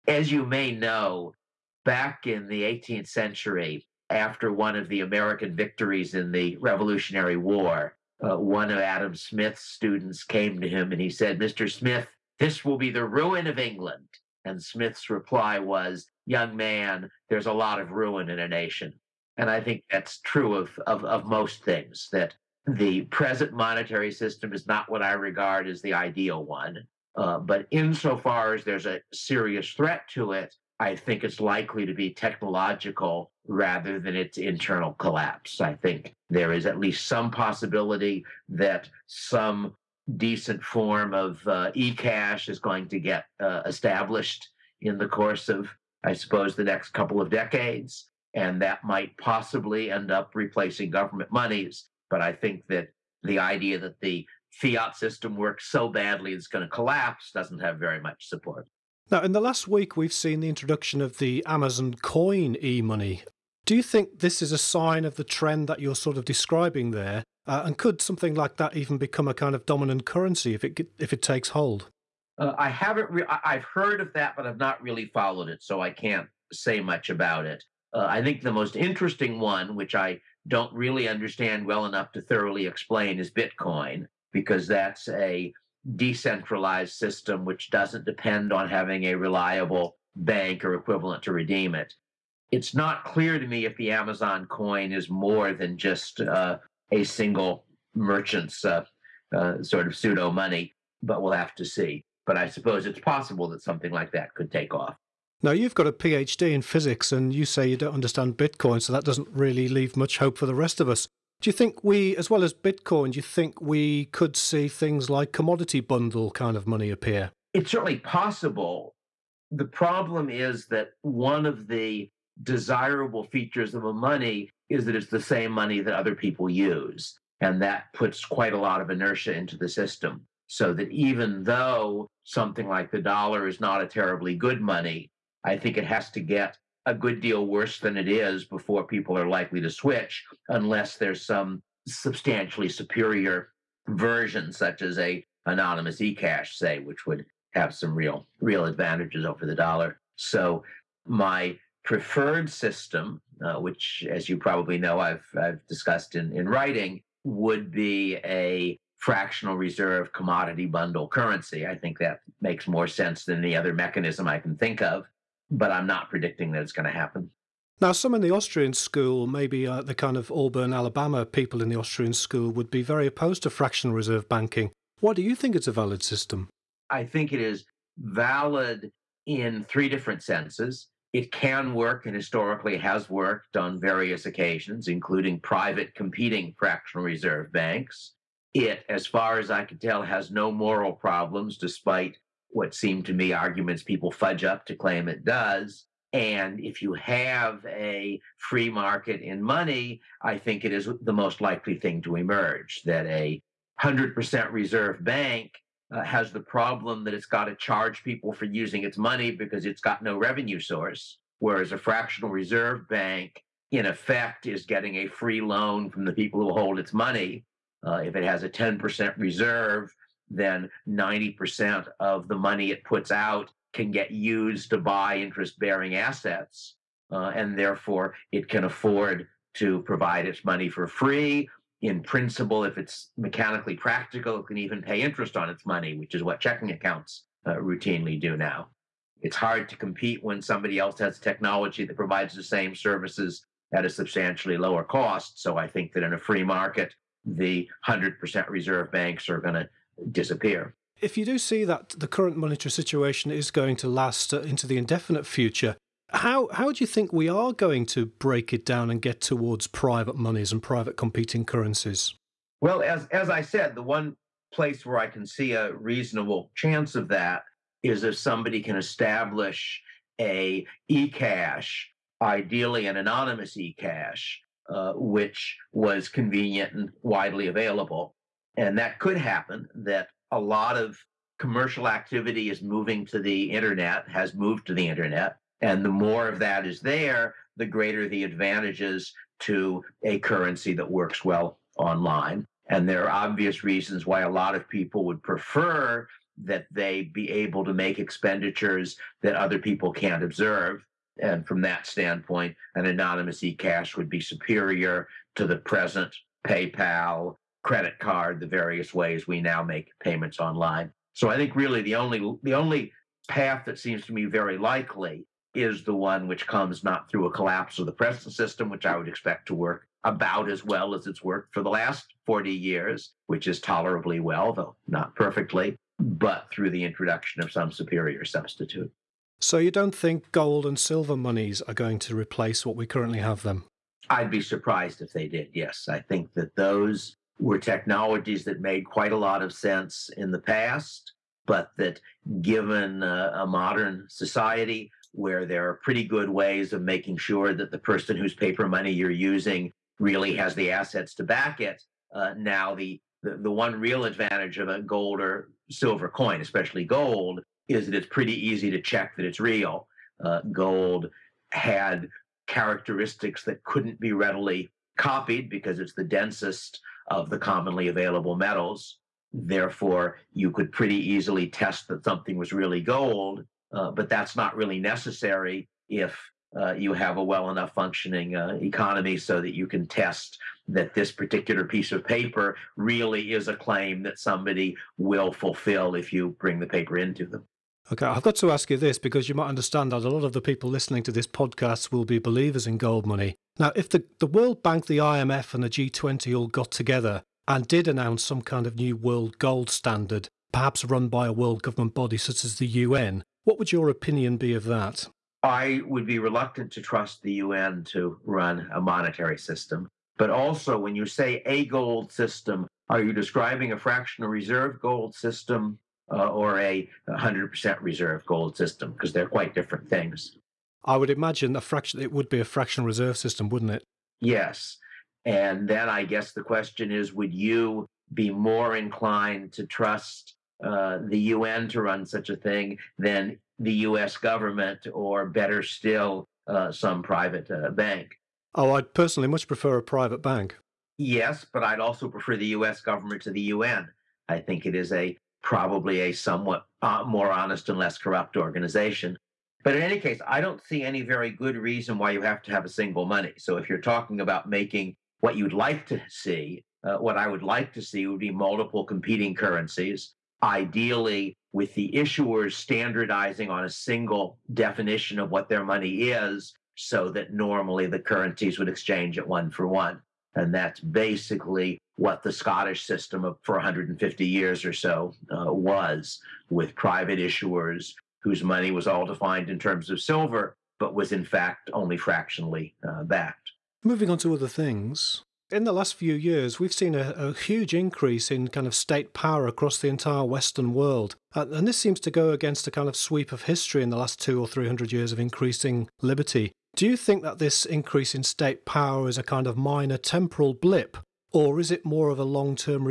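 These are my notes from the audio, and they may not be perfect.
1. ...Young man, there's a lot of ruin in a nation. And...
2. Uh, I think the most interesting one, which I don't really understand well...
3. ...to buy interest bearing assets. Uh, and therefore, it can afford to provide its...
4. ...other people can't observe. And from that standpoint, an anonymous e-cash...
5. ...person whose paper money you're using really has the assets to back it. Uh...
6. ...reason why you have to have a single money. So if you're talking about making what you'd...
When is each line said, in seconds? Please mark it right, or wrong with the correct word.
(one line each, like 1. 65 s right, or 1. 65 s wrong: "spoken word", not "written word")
1. 16 s right
2. 77 s right
3. 224 s right
4. 299 s right
5. 347 s right
6. 451 s right.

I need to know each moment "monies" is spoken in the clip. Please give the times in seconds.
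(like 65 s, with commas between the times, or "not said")
51 s, 260 s, 331 s.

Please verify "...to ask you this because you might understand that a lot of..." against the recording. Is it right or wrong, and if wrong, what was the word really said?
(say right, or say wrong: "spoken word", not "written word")
right.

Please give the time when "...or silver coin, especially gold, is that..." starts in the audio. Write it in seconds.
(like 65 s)
355 s.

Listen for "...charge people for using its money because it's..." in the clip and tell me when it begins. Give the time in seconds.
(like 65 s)
207 s.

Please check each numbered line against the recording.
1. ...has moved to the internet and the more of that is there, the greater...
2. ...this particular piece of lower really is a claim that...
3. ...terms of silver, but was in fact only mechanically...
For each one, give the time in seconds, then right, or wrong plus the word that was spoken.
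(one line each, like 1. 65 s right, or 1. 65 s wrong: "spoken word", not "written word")
1. 284 s right
2. 380 s wrong: "paper", not "lower"
3. 479 s wrong: "fractionally", not "mechanically".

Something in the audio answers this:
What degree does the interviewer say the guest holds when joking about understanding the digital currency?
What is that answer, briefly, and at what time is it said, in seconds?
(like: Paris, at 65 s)
PhD in physics, at 105 s.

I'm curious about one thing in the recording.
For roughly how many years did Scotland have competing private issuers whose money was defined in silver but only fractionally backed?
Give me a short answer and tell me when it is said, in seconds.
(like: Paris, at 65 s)
150, at 473 s.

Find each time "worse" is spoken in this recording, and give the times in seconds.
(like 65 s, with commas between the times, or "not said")
137 s.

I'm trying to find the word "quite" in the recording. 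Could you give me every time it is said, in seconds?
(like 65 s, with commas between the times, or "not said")
128 s, 338 s, 419 s.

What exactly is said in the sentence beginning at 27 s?
Uh, but insofar as there's a serious threat to it, I think it's likely to be technological rather than its internal collapse.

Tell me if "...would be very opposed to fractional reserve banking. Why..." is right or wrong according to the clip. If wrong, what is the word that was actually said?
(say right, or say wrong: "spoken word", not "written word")
right.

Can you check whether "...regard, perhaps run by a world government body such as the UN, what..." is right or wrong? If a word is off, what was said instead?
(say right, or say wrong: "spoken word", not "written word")
wrong: "standard", not "regard".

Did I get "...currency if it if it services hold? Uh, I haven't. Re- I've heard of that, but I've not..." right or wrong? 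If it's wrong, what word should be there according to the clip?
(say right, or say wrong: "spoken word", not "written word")
wrong: "takes", not "services".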